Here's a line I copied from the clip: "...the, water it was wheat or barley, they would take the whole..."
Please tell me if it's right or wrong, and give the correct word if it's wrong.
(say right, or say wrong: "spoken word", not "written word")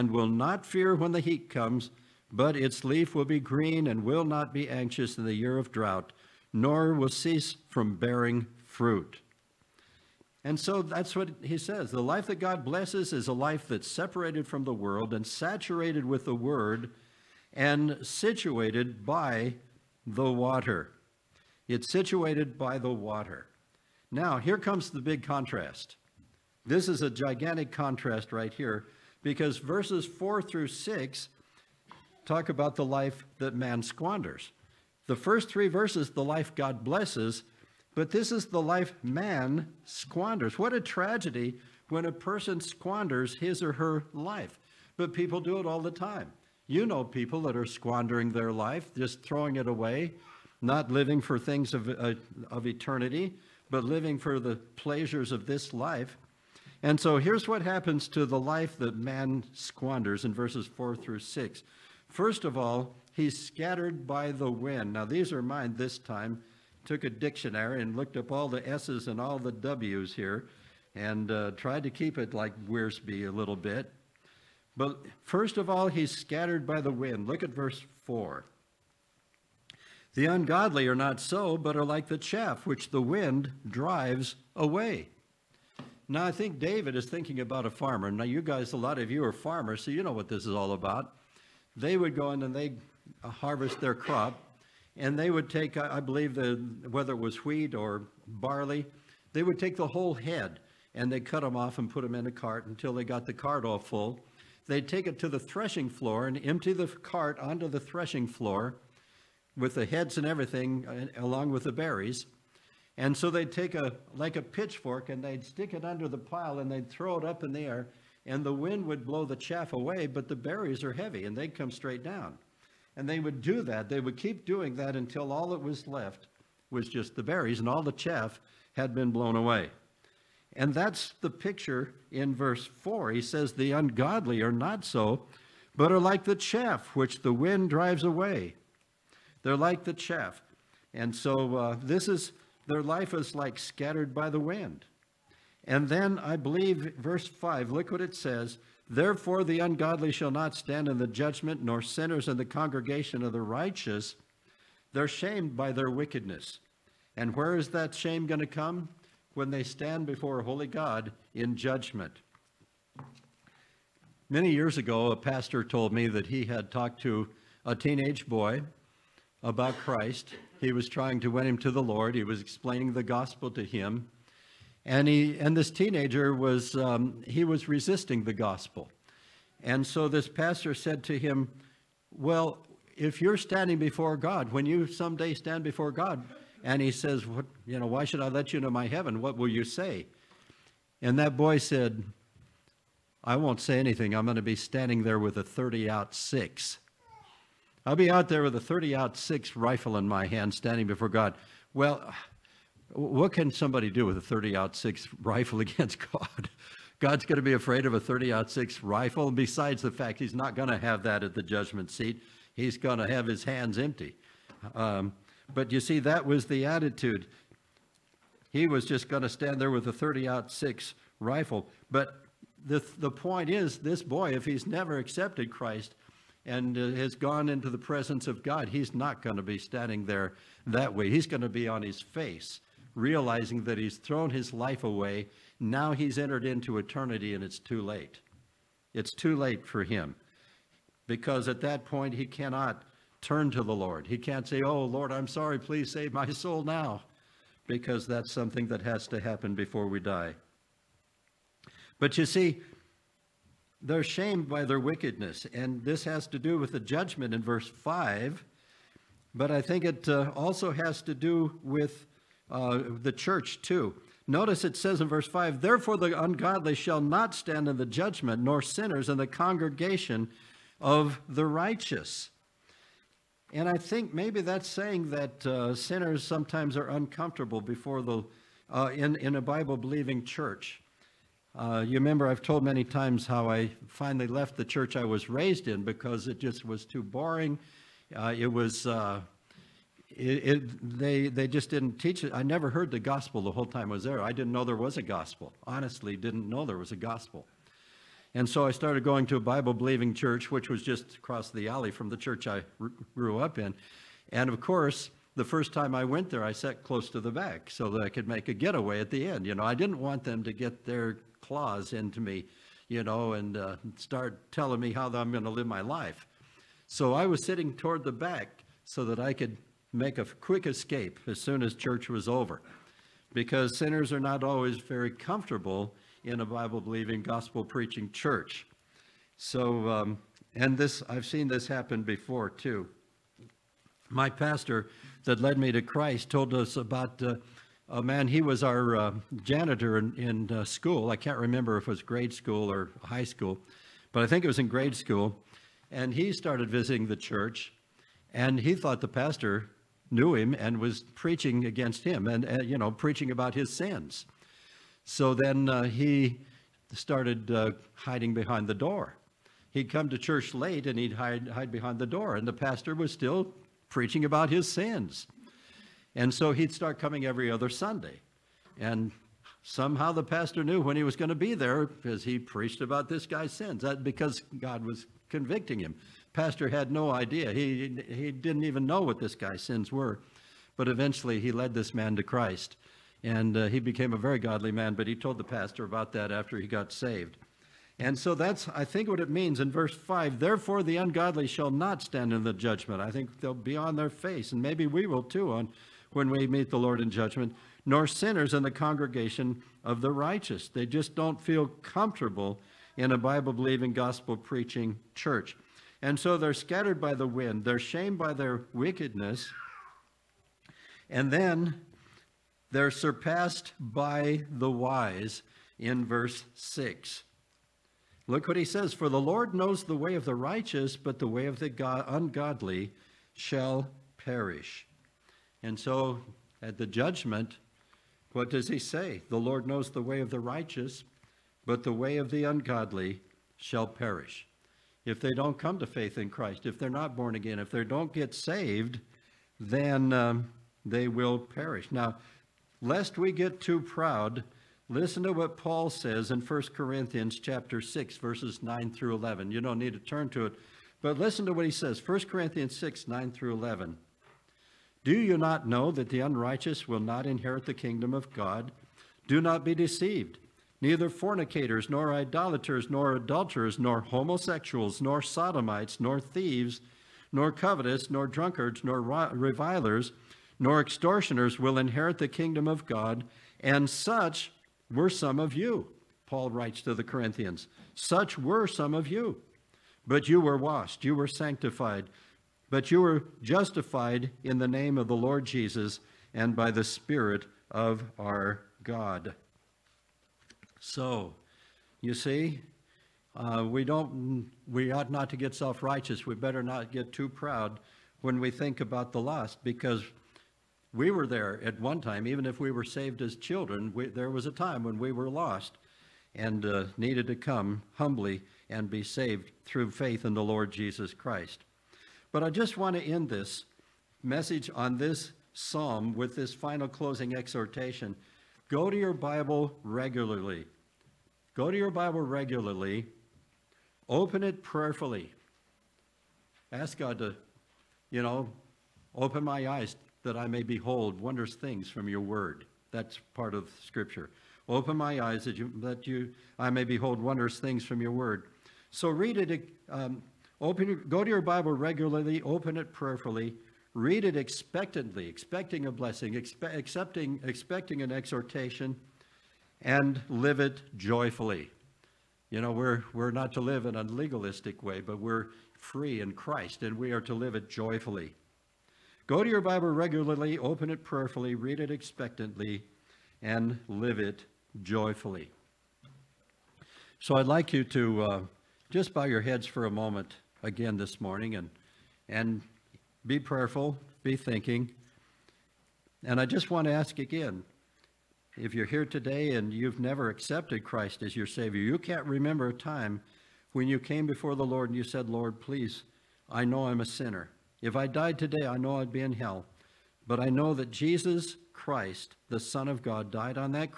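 wrong: "whether", not "water".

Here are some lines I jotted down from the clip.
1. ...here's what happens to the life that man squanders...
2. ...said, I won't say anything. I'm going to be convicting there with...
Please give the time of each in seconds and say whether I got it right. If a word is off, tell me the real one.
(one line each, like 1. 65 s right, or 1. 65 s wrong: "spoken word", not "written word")
1. 57 s right
2. 191 s wrong: "standing", not "convicting".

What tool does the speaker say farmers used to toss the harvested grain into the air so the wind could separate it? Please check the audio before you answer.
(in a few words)
pitchfork.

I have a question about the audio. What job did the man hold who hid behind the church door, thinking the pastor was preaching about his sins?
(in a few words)
janitor.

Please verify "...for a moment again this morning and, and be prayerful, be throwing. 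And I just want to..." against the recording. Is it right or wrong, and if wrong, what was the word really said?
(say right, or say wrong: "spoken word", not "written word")
wrong: "thinking", not "throwing".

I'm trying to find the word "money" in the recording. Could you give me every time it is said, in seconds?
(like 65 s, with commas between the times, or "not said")
not said.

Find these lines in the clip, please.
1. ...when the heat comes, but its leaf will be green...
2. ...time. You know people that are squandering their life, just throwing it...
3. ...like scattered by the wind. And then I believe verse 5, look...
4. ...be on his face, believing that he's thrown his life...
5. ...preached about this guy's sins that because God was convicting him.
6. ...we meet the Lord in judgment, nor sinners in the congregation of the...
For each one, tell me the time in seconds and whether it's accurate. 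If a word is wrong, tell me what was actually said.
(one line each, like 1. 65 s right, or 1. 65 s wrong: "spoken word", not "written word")
1. 0 s right
2. 45 s right
3. 143 s right
4. 231 s wrong: "realizing", not "believing"
5. 372 s right
6. 396 s right.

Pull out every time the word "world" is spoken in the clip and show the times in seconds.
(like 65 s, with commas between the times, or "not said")
14 s.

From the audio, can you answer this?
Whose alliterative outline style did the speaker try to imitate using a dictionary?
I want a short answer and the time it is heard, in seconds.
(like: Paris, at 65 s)
Wiersbe, at 72 s.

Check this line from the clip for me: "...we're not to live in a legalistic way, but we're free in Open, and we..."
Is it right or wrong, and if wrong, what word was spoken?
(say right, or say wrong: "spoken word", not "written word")
wrong: "Christ", not "Open".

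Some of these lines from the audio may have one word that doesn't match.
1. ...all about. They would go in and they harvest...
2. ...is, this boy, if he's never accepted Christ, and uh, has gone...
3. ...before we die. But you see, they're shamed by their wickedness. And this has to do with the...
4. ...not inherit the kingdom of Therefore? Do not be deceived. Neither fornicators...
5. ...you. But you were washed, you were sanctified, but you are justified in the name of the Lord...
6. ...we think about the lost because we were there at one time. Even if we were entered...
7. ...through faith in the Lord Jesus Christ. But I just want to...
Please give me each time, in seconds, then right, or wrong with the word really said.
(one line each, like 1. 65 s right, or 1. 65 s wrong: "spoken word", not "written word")
1. 90 s right
2. 223 s right
3. 249 s right
4. 456 s wrong: "God", not "Therefore"
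5. 479 s right
6. 498 s wrong: "saved", not "entered"
7. 509 s right.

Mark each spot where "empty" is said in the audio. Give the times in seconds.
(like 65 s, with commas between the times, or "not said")
106 s, 213 s.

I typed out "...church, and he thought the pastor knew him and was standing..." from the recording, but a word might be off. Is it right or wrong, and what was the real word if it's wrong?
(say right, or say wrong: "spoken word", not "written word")
wrong: "preaching", not "standing".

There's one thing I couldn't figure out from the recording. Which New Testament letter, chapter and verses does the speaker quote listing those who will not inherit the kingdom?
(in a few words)
1 Corinthians 6:9-11.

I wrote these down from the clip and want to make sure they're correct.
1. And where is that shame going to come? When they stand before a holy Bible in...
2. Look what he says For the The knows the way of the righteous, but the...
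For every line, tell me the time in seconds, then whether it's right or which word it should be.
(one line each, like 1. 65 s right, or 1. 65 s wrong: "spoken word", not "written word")
1. 157 s wrong: "God", not "Bible"
2. 418 s wrong: "Lord", not "The".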